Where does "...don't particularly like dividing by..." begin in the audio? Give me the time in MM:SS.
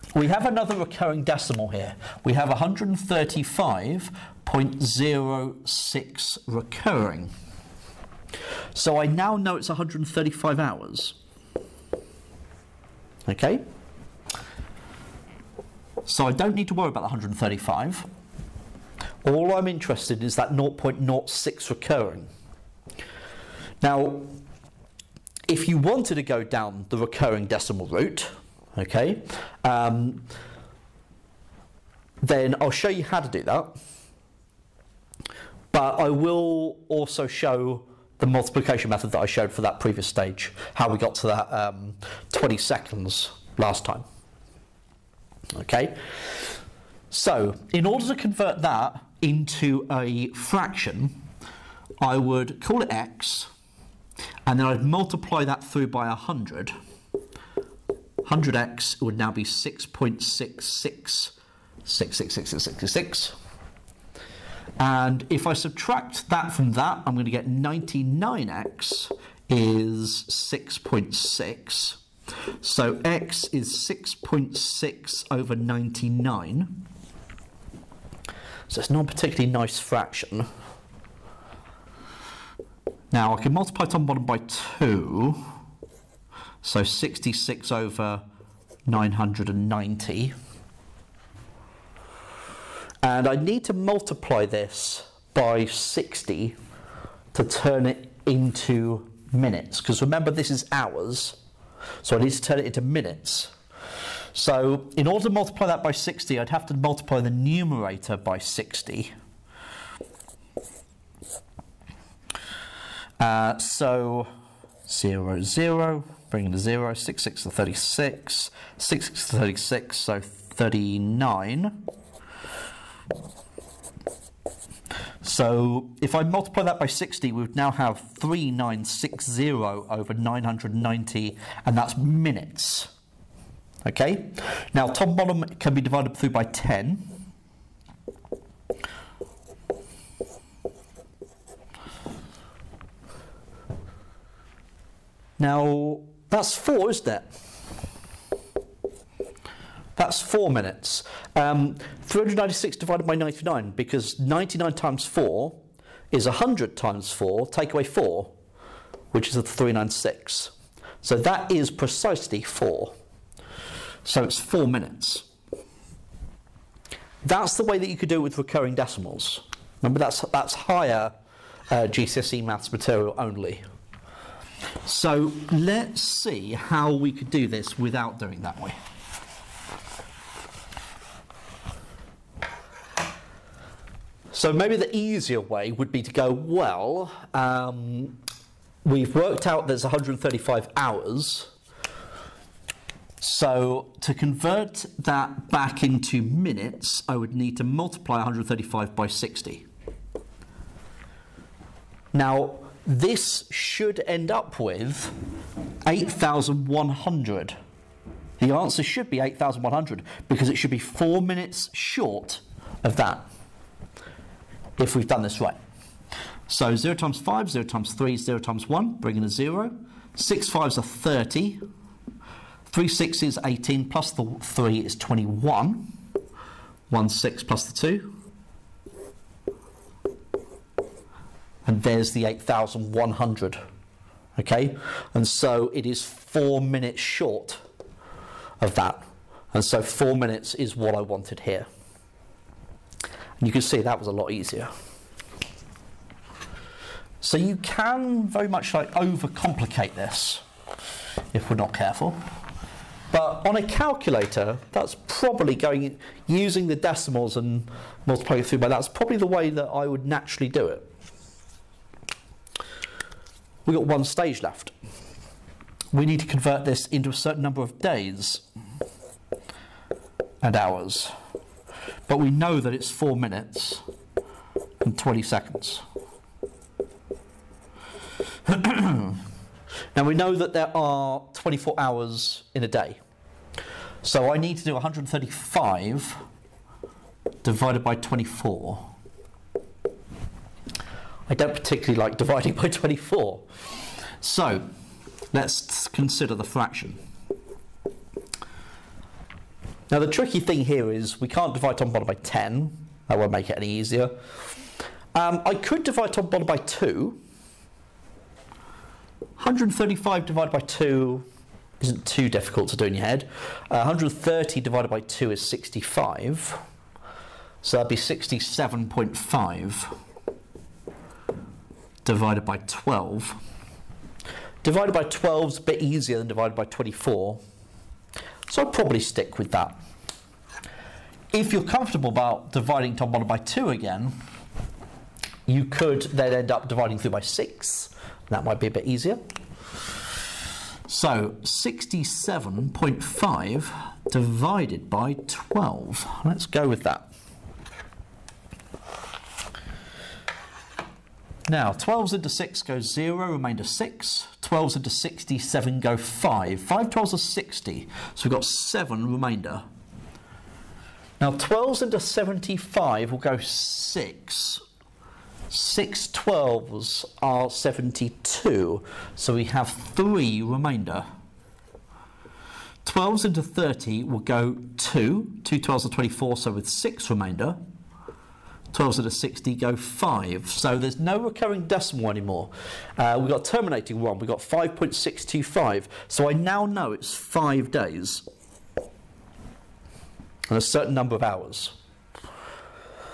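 04:51.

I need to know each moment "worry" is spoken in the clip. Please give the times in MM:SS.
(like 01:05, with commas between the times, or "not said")
00:16.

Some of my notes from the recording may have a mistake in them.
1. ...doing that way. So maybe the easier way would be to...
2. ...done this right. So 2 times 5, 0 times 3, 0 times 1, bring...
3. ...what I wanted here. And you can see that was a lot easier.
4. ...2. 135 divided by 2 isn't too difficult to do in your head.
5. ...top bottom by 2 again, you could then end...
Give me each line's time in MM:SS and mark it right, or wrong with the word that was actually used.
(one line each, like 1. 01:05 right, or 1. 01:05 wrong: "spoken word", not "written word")
1. 02:58 right
2. 03:35 wrong: "0", not "2"
3. 04:00 right
4. 05:06 right
5. 05:32 right.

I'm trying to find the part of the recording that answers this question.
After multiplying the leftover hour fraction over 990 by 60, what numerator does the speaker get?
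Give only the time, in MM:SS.
02:08.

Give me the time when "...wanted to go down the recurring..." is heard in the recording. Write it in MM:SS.
00:25.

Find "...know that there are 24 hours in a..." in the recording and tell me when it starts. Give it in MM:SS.
04:40.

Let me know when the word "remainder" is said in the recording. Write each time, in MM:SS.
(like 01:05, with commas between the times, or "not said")
05:53, 05:59, 06:10, 06:17.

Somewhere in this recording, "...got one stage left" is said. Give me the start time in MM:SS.
04:23.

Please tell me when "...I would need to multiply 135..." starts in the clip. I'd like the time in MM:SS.
03:17.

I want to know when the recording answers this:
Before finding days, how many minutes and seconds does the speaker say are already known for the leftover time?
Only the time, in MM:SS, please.
04:32.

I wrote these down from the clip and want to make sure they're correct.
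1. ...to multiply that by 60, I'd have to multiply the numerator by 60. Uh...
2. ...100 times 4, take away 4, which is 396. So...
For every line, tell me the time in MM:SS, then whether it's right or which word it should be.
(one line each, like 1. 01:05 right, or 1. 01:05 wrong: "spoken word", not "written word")
1. 01:45 right
2. 02:36 right.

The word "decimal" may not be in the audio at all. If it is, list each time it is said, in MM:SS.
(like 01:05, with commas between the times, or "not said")
00:01, 00:27, 02:48, 04:16, 06:21.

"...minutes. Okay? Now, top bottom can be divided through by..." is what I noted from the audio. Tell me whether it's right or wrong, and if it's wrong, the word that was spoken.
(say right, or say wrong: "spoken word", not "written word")
right.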